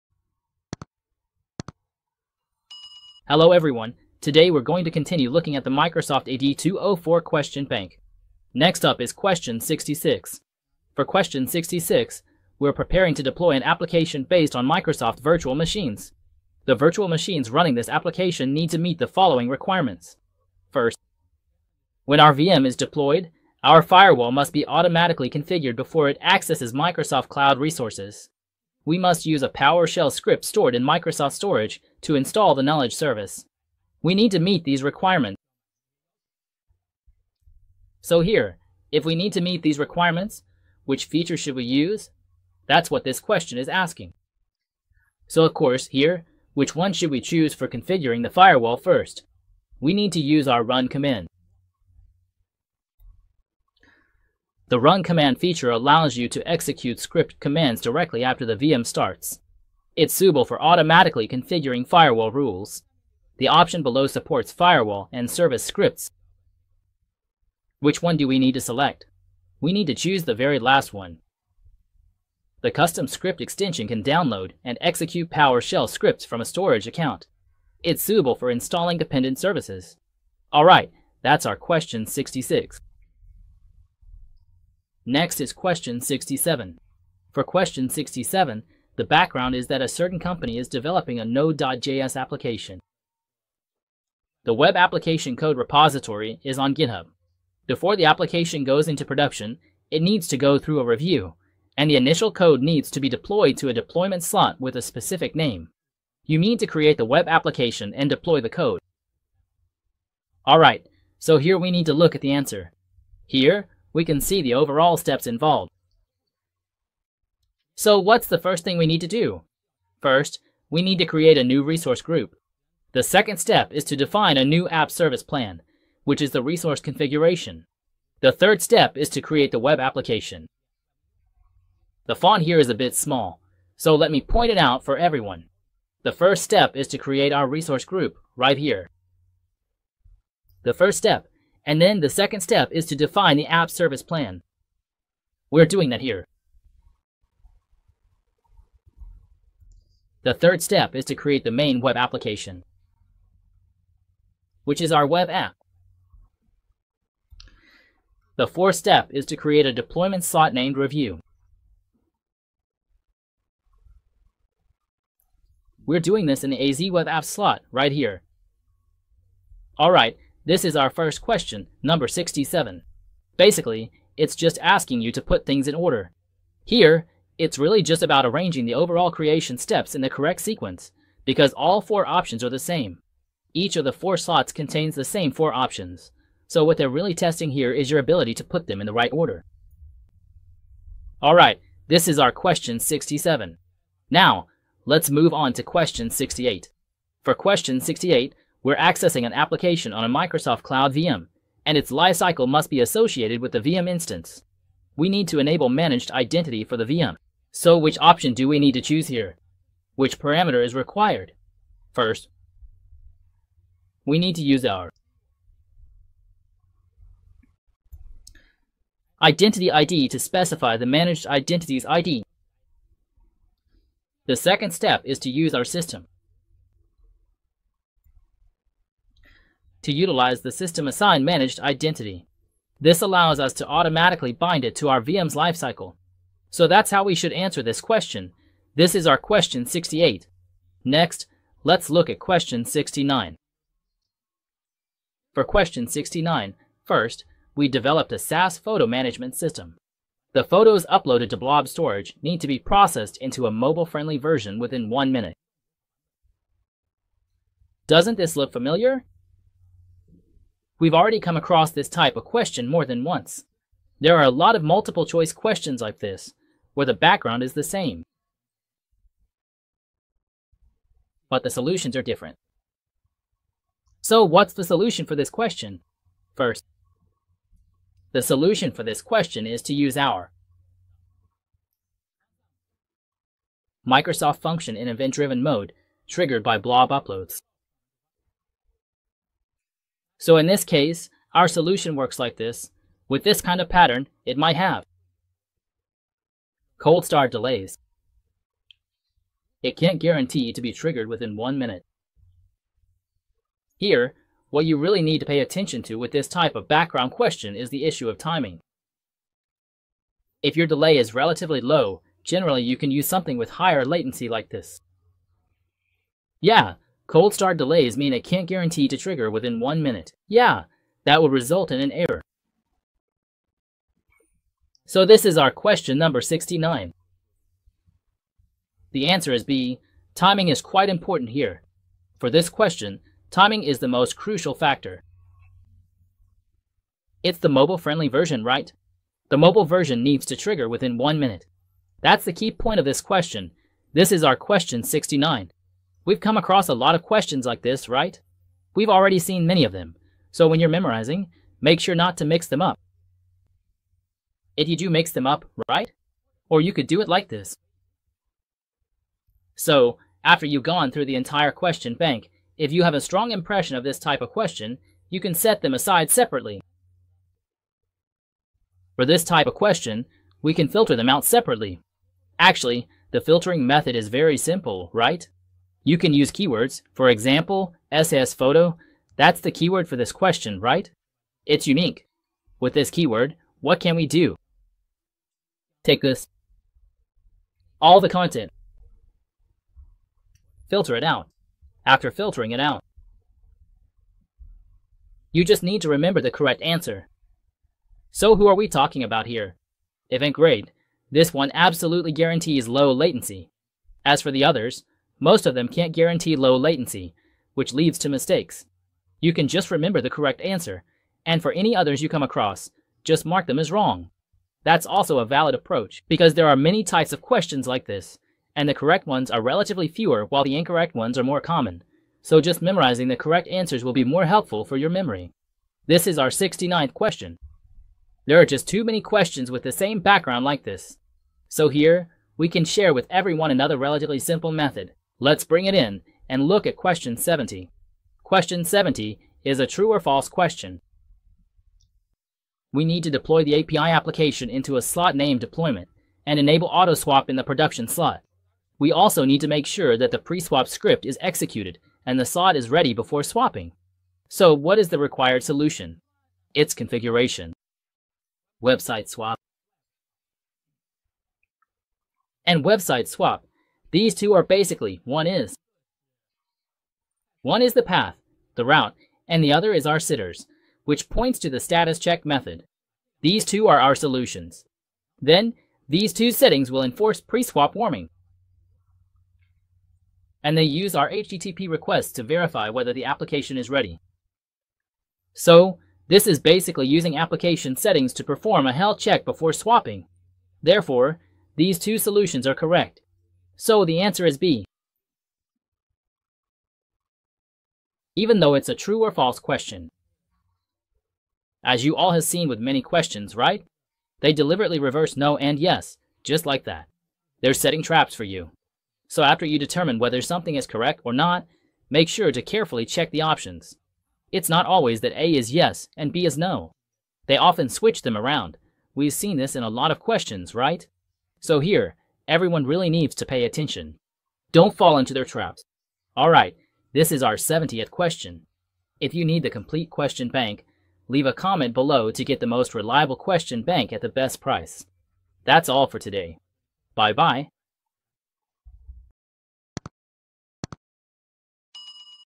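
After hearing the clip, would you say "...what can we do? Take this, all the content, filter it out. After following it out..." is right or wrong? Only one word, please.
wrong.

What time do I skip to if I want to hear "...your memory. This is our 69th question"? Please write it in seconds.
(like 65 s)
424 s.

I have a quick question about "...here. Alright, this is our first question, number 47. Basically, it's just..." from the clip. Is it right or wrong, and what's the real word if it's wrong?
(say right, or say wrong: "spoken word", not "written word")
wrong: "67", not "47".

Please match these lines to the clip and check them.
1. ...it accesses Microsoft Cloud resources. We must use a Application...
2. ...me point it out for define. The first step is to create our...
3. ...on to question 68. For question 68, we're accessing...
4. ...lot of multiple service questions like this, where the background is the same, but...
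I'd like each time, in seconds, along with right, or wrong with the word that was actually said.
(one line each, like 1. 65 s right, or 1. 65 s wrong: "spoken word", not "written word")
1. 26 s wrong: "PowerShell", not "Application"
2. 134 s wrong: "everyone", not "define"
3. 195 s right
4. 264 s wrong: "choice", not "service".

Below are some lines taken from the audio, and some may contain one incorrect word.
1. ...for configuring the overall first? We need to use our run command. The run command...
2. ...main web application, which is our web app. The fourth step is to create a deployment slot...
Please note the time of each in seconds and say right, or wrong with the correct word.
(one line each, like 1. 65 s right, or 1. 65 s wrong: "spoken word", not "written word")
1. 47 s wrong: "firewall", not "overall"
2. 151 s right.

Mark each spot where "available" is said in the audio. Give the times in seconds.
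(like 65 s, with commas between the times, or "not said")
not said.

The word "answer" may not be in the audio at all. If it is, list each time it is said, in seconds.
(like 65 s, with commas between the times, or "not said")
112 s, 237 s, 329 s, 396 s, 410 s, 423 s, 494 s.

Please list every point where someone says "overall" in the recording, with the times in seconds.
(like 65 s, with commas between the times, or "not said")
114 s, 178 s.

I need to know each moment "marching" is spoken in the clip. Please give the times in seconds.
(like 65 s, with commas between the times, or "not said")
not said.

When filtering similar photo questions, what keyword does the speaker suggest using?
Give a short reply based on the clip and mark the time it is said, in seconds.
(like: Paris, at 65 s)
SS photo, at 377 s.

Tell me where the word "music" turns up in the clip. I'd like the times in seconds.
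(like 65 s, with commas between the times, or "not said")
not said.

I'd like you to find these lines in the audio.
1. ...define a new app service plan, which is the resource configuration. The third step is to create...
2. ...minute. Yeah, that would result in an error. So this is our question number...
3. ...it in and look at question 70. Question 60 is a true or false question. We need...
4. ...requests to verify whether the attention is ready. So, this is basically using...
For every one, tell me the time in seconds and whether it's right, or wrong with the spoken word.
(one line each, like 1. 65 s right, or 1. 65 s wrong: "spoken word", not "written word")
1. 123 s right
2. 319 s right
3. 435 s wrong: "70", not "60"
4. 481 s wrong: "application", not "attention".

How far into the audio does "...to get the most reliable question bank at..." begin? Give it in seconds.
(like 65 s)
532 s.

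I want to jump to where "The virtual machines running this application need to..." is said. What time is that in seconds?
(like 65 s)
16 s.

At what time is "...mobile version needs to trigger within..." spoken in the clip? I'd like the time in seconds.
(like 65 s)
339 s.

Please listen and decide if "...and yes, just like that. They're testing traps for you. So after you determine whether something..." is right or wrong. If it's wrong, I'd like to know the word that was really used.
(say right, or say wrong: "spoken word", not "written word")
wrong: "setting", not "testing".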